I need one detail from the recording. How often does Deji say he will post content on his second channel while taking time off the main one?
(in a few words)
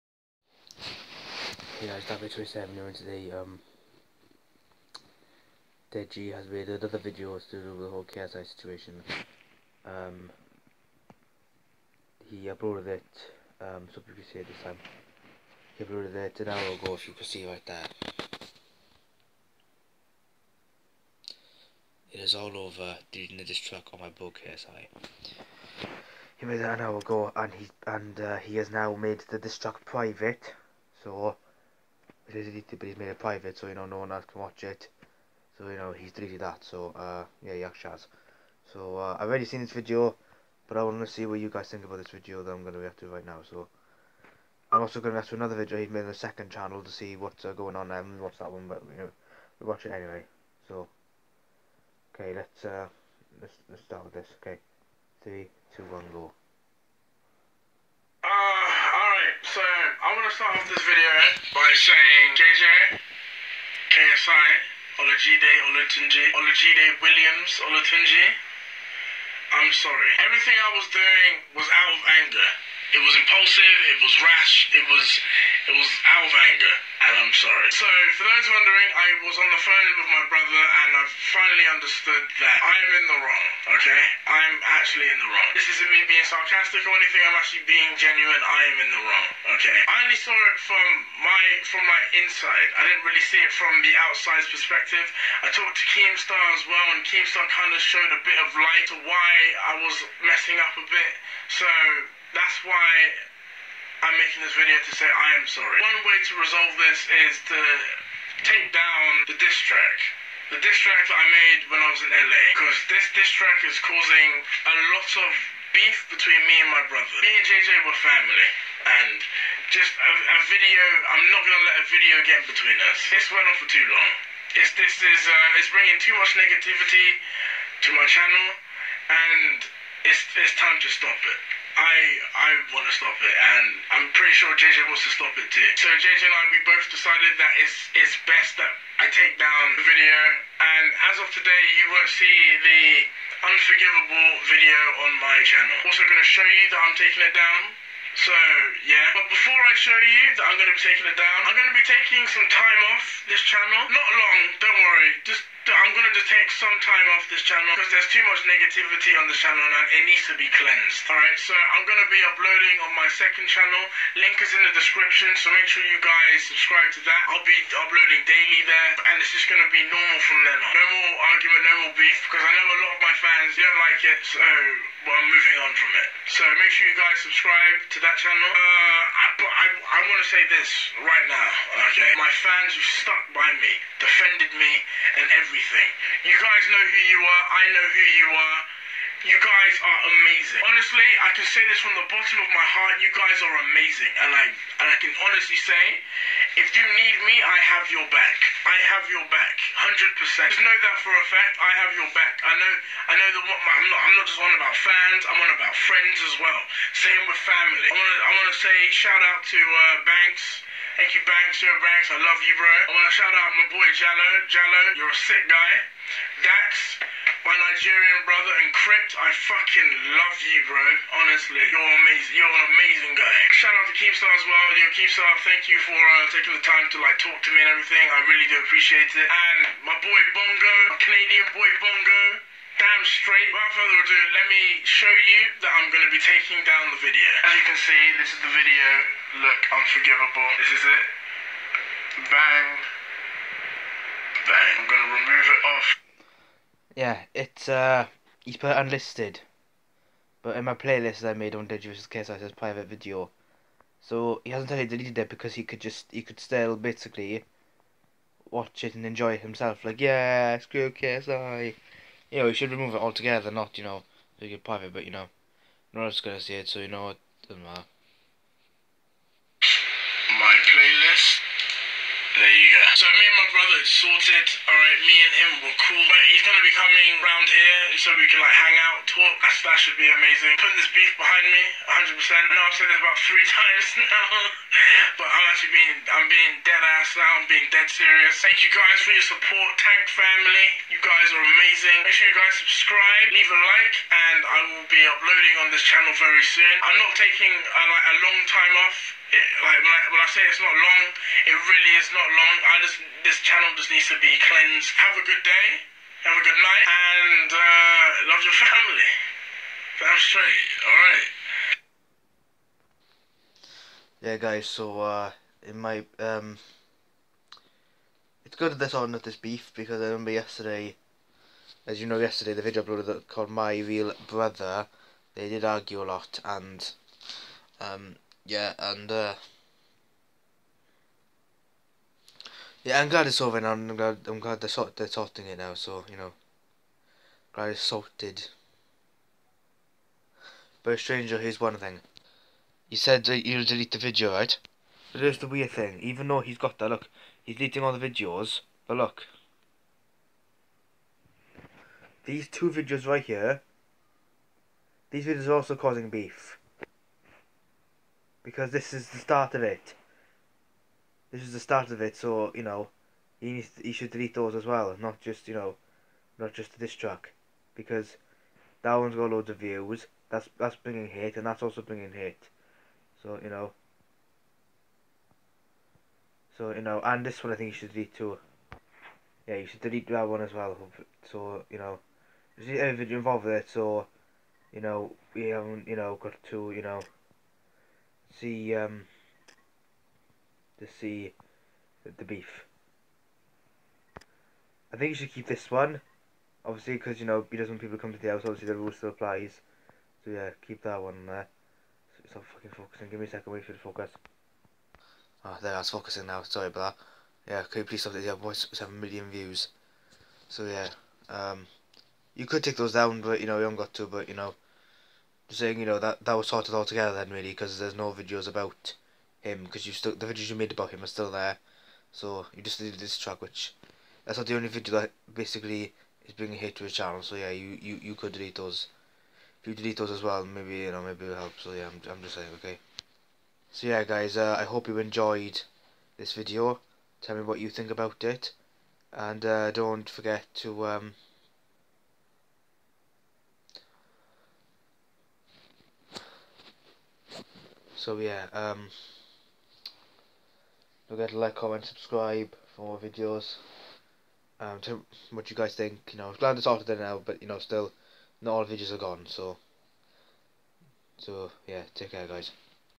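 Daily.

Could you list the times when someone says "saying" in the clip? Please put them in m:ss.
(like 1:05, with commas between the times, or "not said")
1:01, 6:55, 7:12.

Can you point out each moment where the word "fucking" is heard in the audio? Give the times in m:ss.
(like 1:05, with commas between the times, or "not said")
3:39, 6:42.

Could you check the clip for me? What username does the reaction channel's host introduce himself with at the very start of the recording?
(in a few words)
DarkBlade27.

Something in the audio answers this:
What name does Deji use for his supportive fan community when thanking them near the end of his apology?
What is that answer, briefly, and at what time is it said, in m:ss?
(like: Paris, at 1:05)
Tank family, at 4:49.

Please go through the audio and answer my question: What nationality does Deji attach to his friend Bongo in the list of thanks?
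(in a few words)
Canadian.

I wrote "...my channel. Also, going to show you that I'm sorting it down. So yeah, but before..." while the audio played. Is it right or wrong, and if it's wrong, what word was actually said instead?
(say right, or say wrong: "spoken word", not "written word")
wrong: "taking", not "sorting".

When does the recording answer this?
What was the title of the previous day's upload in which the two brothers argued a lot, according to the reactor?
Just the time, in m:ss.
5:23.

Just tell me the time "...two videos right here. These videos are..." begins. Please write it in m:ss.
5:52.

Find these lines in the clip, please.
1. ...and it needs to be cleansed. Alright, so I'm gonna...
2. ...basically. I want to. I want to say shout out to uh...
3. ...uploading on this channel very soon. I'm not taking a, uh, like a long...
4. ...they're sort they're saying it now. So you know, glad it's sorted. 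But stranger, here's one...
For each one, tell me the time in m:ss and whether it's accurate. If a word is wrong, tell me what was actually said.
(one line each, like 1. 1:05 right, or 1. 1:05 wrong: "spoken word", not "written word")
1. 2:39 right
2. 3:27 wrong: "family", not "basically"
3. 4:55 right
4. 5:34 wrong: "sorting", not "saying".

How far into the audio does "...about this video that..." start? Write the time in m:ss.
0:41.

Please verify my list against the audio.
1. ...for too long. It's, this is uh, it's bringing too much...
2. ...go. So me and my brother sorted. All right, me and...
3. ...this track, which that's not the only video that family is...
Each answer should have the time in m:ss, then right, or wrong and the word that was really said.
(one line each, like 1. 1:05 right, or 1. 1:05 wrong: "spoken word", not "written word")
1. 2:03 right
2. 4:32 right
3. 7:02 wrong: "basically", not "family".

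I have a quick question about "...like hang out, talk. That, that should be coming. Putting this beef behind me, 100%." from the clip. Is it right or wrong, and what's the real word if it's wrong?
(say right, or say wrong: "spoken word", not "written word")
wrong: "amazing", not "coming".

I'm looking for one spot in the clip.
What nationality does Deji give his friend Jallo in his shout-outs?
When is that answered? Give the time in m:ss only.
3:37.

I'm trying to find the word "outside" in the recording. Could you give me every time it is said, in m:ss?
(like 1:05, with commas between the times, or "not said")
1:34.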